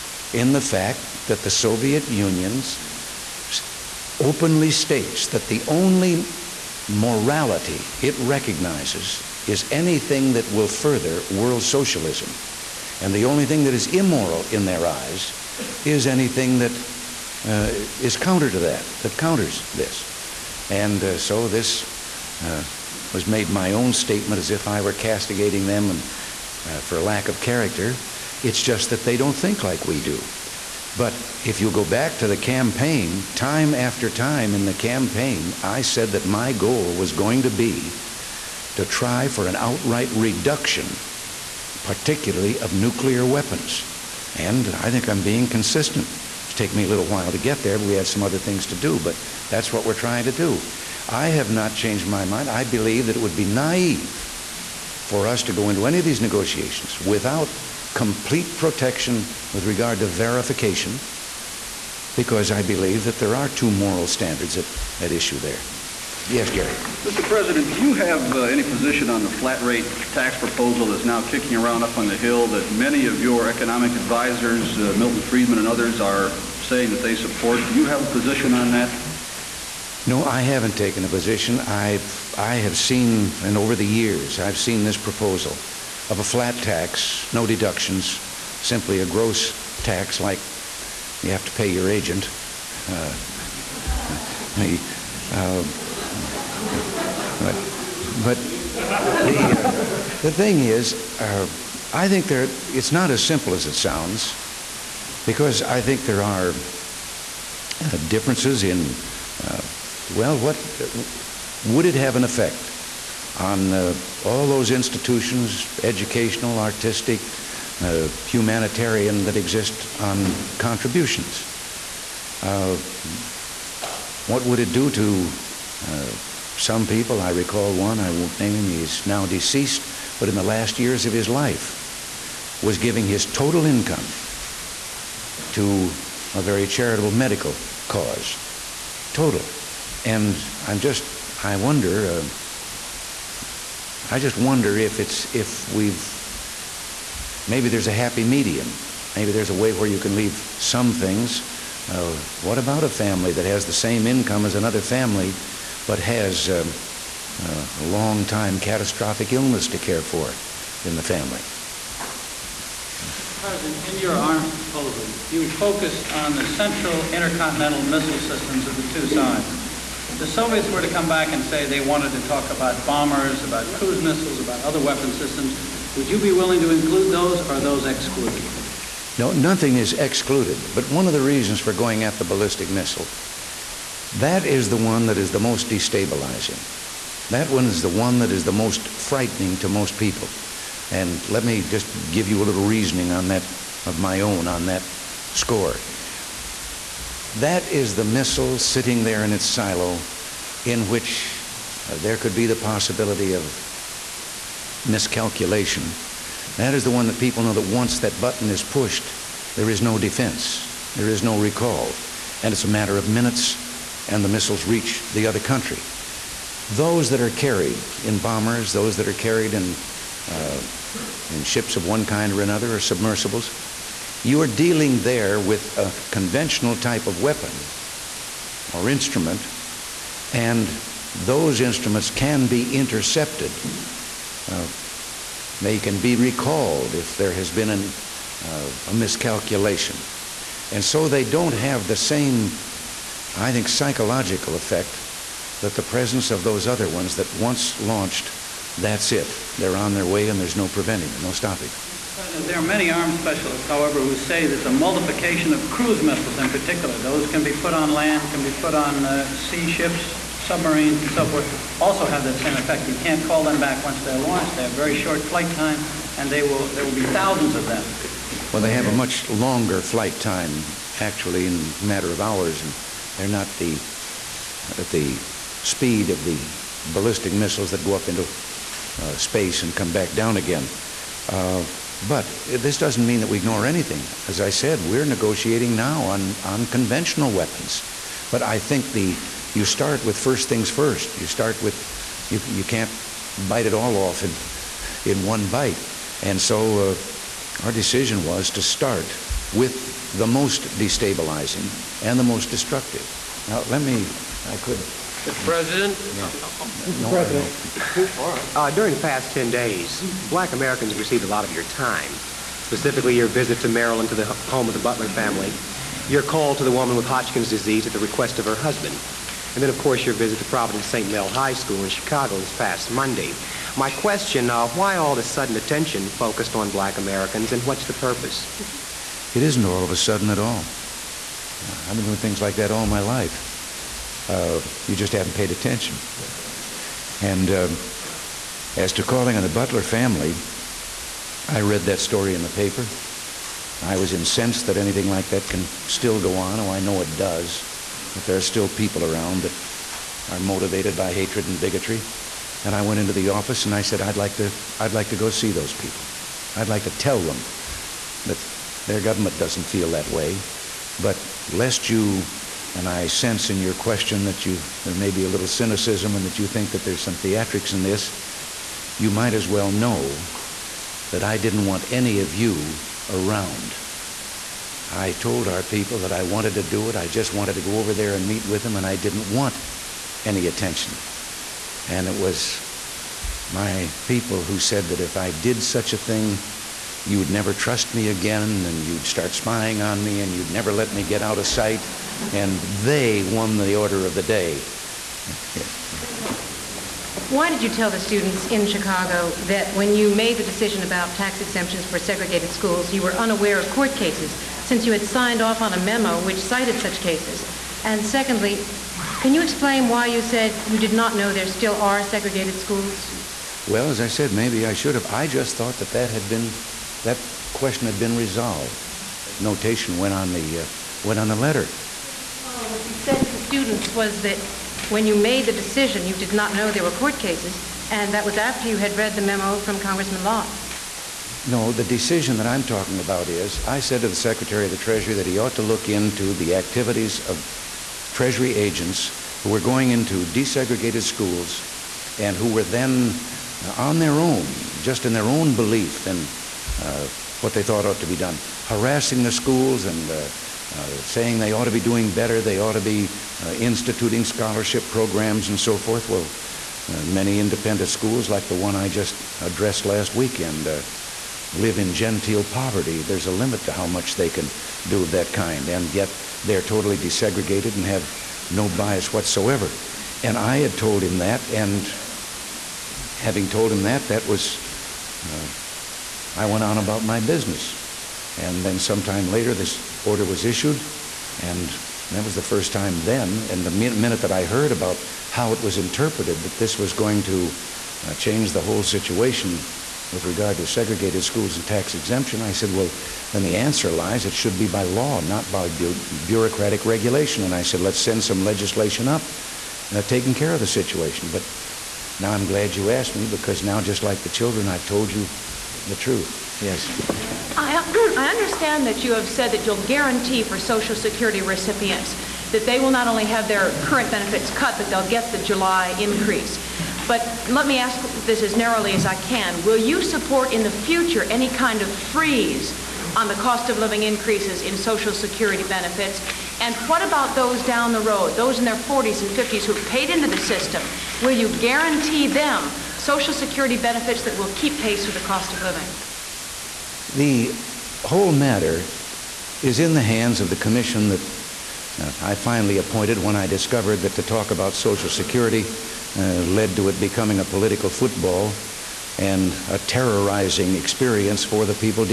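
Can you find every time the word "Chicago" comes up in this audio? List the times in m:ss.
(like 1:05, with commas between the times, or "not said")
5:21, 6:38.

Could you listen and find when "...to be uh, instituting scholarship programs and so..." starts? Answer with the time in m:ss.
7:32.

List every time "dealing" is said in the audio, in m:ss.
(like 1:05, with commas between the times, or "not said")
3:44.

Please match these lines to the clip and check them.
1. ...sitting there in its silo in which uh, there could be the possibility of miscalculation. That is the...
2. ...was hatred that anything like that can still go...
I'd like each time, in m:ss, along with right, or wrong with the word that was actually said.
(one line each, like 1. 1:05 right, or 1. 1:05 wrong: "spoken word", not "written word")
1. 3:18 right
2. 5:43 wrong: "incensed", not "hatred".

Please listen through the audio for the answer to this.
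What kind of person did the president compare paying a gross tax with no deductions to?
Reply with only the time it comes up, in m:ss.
1:31.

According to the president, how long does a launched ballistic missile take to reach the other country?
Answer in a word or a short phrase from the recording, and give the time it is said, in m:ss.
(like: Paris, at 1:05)
A matter of minutes, at 3:32.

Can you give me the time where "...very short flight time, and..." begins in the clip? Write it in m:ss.
4:24.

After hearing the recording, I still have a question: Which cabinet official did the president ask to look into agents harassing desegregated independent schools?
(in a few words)
Secretary of the Treasury.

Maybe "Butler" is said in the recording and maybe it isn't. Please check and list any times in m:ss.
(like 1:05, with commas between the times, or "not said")
5:14, 5:39.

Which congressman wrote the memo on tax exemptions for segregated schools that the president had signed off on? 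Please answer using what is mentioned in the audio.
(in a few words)
Congressman Lott.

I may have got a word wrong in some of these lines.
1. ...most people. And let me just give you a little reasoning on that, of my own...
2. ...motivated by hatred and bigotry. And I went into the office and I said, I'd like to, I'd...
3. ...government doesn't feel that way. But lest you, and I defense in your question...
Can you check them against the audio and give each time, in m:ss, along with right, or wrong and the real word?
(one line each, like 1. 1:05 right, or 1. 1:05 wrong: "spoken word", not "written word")
1. 3:09 right
2. 5:50 right
3. 5:59 wrong: "sense", not "defense".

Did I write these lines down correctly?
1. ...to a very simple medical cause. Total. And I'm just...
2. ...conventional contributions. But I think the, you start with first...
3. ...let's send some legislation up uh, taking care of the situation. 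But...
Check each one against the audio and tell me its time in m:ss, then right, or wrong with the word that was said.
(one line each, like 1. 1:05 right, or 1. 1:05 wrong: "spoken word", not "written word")
1. 2:15 wrong: "charitable", not "simple"
2. 4:46 wrong: "weapons", not "contributions"
3. 8:17 right.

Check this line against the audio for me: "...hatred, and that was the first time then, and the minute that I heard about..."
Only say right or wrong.
wrong.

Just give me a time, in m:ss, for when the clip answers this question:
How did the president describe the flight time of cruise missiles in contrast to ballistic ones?
4:31.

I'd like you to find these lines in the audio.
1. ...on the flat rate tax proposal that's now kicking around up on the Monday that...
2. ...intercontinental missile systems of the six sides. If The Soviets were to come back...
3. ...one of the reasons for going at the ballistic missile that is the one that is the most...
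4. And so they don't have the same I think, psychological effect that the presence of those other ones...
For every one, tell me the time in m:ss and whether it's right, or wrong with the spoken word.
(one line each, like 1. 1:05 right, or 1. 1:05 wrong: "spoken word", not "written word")
1. 1:09 wrong: "Hill", not "Monday"
2. 2:47 wrong: "two", not "six"
3. 3:00 right
4. 4:00 right.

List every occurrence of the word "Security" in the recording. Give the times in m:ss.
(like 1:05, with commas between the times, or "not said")
8:30, 8:45, 8:53, 9:05.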